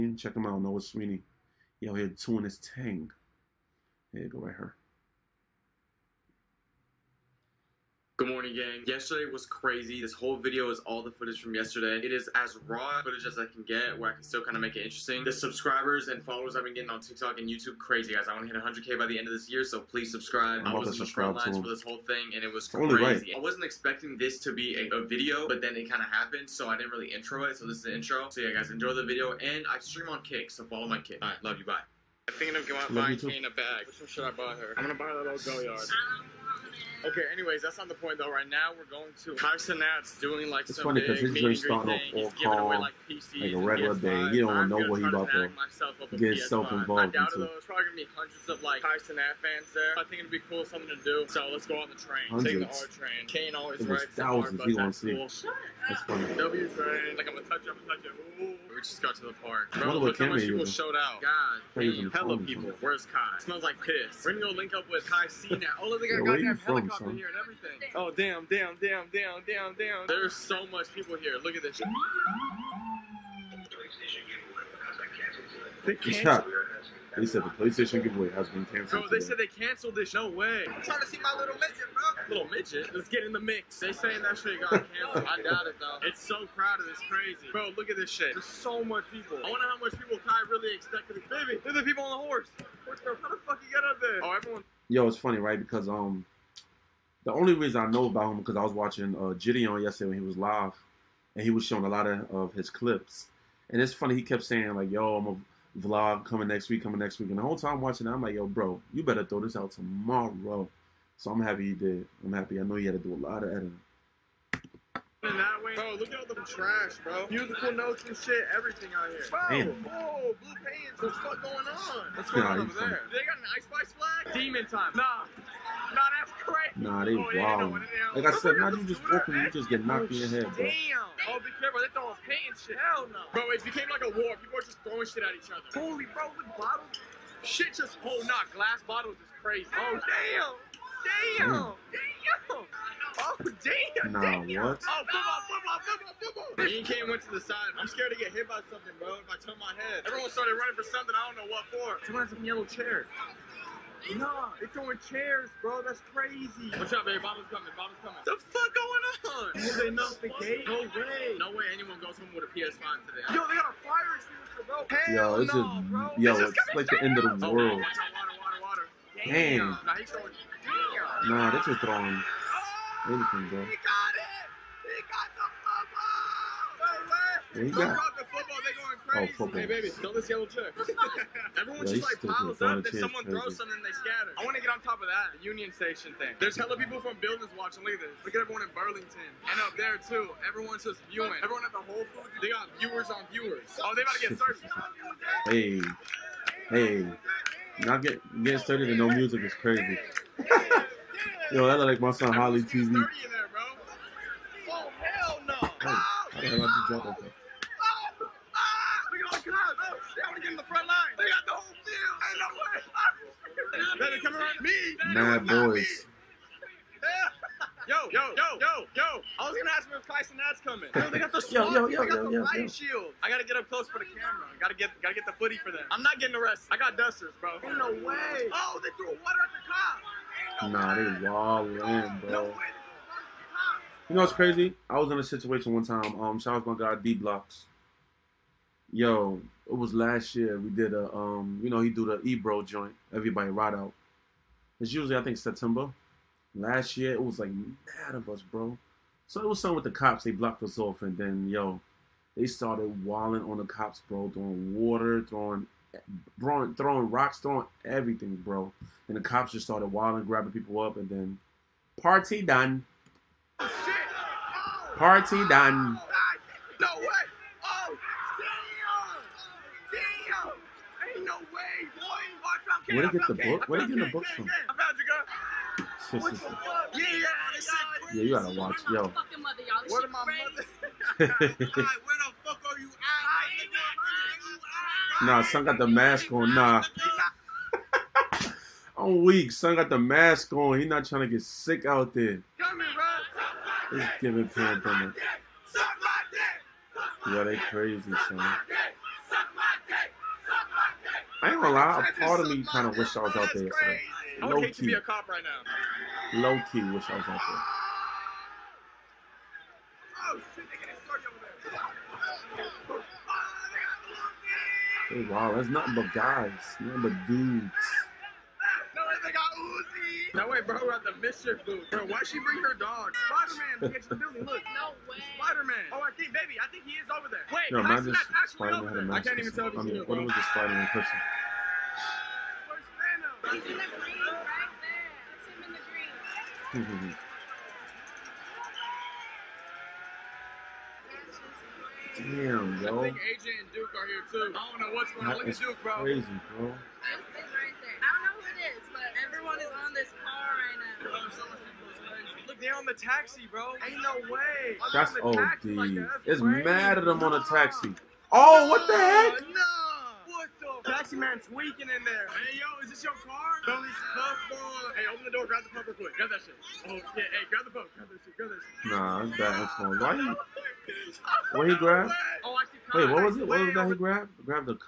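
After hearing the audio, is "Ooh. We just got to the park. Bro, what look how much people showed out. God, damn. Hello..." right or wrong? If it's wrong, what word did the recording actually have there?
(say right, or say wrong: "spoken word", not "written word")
right.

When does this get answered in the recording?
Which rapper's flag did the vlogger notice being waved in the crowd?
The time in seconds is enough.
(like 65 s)
123 s.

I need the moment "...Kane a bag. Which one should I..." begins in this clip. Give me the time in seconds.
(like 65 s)
33 s.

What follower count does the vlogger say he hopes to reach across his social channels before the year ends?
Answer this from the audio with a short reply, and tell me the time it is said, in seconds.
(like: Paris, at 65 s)
100K, at 18 s.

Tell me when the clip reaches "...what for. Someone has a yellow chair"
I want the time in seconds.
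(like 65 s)
151 s.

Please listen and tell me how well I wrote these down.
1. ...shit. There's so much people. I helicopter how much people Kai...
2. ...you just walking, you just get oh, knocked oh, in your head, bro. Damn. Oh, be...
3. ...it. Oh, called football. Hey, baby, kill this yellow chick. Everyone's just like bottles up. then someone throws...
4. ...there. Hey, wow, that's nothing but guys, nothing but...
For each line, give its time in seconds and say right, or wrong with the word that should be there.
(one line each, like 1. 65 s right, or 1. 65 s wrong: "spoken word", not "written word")
1. 88 s wrong: "wonder", not "helicopter"
2. 128 s right
3. 177 s wrong: "piles", not "bottles"
4. 315 s right.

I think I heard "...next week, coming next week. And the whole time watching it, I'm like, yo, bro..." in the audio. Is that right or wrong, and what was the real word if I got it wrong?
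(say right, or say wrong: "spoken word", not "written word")
right.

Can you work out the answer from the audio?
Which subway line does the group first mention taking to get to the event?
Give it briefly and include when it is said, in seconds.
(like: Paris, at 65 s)
R train, at 52 s.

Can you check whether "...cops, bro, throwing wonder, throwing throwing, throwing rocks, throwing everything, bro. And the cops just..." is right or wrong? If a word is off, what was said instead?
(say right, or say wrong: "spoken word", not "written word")
wrong: "water", not "wonder".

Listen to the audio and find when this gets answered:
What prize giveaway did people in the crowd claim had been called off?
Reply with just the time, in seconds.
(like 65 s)
77 s.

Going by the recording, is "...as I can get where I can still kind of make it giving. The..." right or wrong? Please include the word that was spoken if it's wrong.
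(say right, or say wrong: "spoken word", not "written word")
wrong: "interesting", not "giving".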